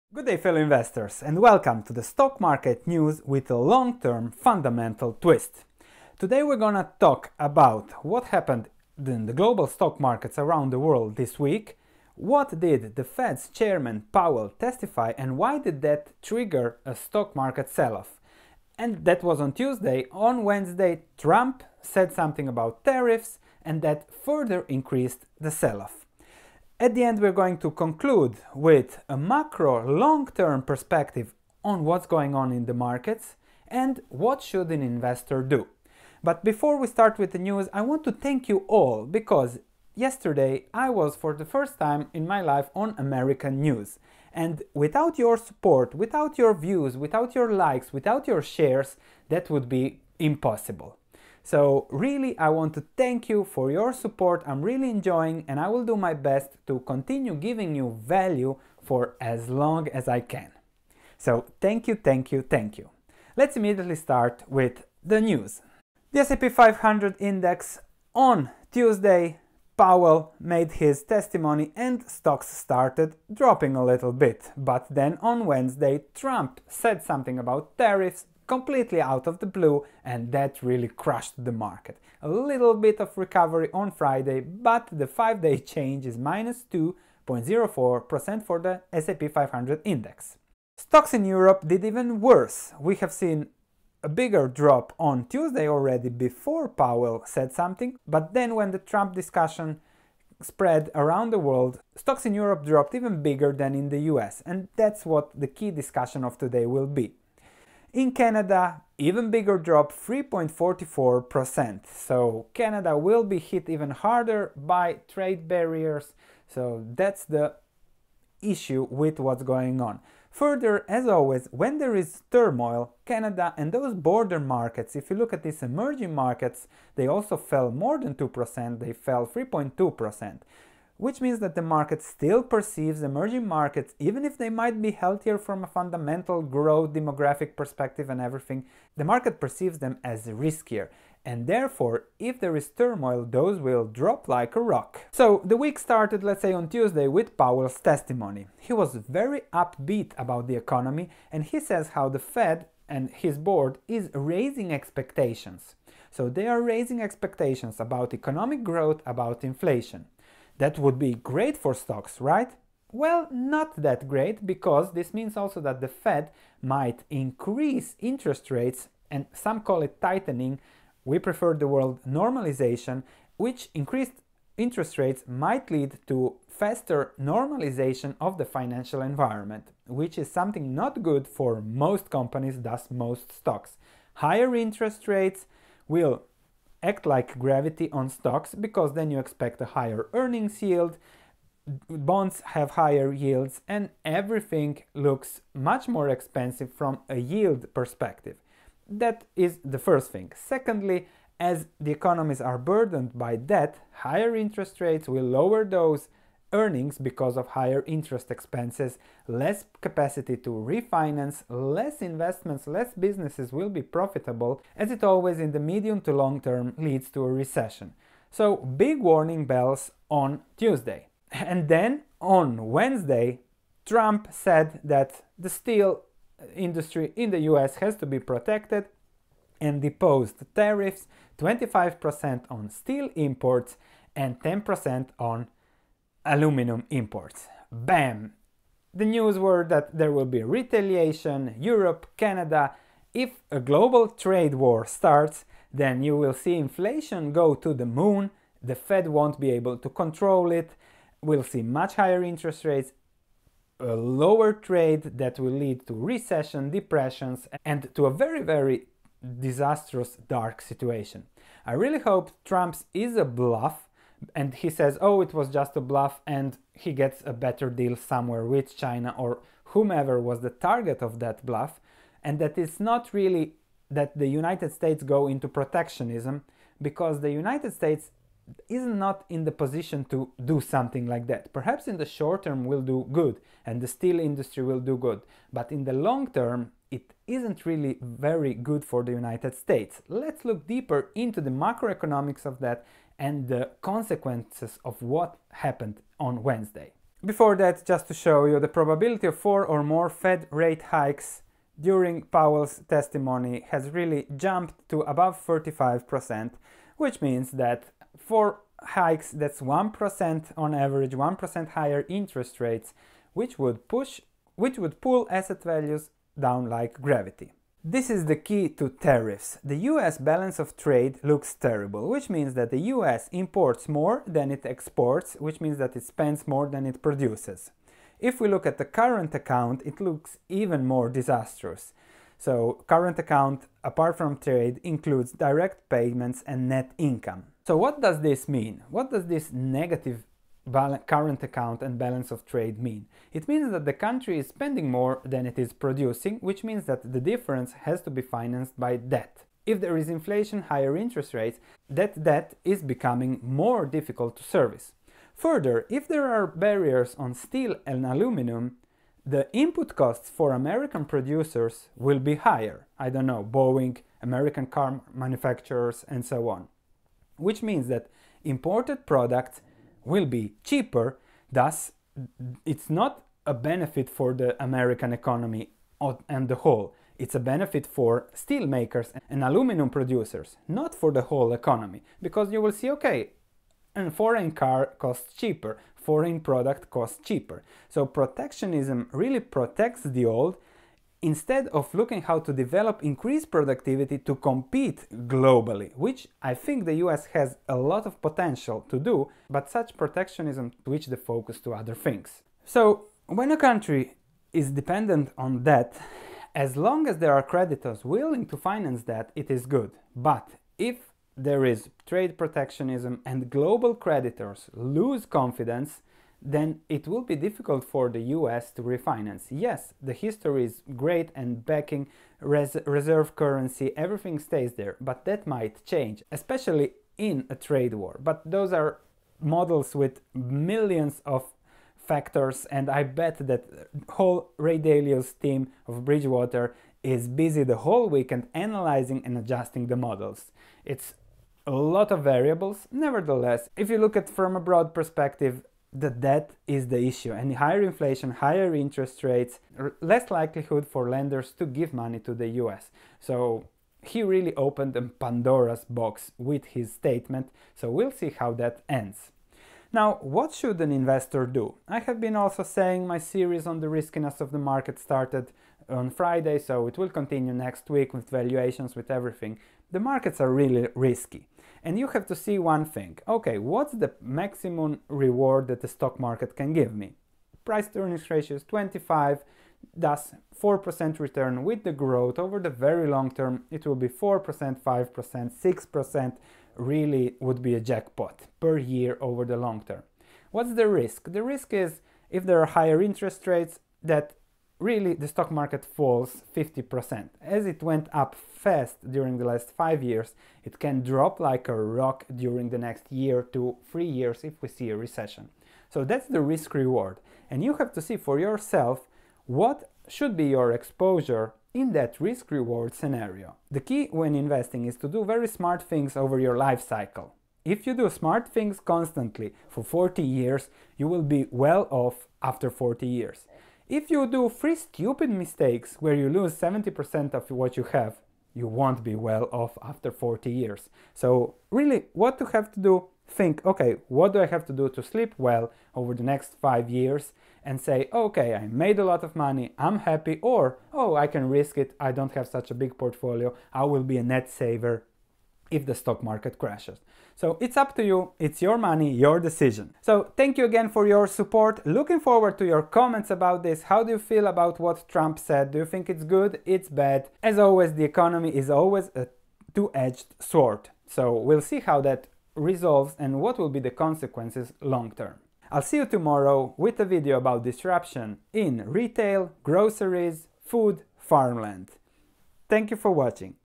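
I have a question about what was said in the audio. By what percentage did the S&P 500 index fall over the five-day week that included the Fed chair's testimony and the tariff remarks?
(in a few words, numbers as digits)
2.04%.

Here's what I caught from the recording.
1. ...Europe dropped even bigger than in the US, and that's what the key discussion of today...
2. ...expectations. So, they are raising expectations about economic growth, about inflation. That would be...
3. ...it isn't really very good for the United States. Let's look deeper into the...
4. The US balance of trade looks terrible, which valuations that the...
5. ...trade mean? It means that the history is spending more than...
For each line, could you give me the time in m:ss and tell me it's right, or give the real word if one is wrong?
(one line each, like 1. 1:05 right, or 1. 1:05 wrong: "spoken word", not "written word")
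1. 1:42 right
2. 2:34 right
3. 4:46 right
4. 5:19 wrong: "means", not "valuations"
5. 5:42 wrong: "country", not "history".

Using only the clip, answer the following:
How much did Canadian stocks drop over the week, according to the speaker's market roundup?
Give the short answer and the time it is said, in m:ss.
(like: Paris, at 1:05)
3.44%, at 1:49.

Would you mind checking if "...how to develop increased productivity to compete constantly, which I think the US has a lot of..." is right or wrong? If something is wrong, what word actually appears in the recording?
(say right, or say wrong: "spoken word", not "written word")
wrong: "globally", not "constantly".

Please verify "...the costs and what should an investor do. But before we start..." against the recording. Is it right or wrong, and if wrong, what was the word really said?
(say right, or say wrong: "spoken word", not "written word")
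wrong: "markets", not "costs".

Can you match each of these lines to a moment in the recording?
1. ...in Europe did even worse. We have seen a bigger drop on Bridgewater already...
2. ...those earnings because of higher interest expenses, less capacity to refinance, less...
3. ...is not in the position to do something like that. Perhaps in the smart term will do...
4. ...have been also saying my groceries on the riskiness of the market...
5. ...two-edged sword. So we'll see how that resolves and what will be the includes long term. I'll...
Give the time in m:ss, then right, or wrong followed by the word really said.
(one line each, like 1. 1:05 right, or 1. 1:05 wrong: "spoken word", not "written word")
1. 1:31 wrong: "Tuesday", not "Bridgewater"
2. 3:25 right
3. 4:38 wrong: "short", not "smart"
4. 7:41 wrong: "series", not "groceries"
5. 9:19 wrong: "consequences", not "includes".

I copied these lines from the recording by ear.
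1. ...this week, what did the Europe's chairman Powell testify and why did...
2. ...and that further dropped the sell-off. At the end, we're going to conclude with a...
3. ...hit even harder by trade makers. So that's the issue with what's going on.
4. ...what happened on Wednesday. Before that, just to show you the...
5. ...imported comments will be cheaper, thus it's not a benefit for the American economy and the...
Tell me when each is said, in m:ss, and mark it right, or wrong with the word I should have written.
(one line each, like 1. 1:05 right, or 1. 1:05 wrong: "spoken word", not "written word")
1. 0:11 wrong: "Fed", not "Europe"
2. 0:23 wrong: "increased", not "dropped"
3. 1:53 wrong: "barriers", not "makers"
4. 4:54 right
5. 6:08 wrong: "products", not "comments".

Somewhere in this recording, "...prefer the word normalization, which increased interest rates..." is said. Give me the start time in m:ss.
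2:51.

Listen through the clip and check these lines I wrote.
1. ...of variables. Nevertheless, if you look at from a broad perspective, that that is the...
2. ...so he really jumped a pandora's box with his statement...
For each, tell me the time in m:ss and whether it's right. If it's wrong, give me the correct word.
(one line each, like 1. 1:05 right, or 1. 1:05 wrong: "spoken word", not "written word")
1. 7:22 right
2. 7:33 wrong: "opened", not "jumped".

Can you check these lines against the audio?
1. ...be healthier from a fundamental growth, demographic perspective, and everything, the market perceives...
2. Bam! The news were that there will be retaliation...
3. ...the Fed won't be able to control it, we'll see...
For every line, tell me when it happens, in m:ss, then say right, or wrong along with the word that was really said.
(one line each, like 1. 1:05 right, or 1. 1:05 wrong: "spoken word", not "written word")
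1. 2:14 right
2. 3:57 right
3. 4:08 right.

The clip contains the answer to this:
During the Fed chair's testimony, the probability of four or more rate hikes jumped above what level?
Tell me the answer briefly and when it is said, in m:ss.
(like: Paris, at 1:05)
35%, at 5:05.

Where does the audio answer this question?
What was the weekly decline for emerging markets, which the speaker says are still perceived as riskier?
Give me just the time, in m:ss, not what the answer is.
2:09.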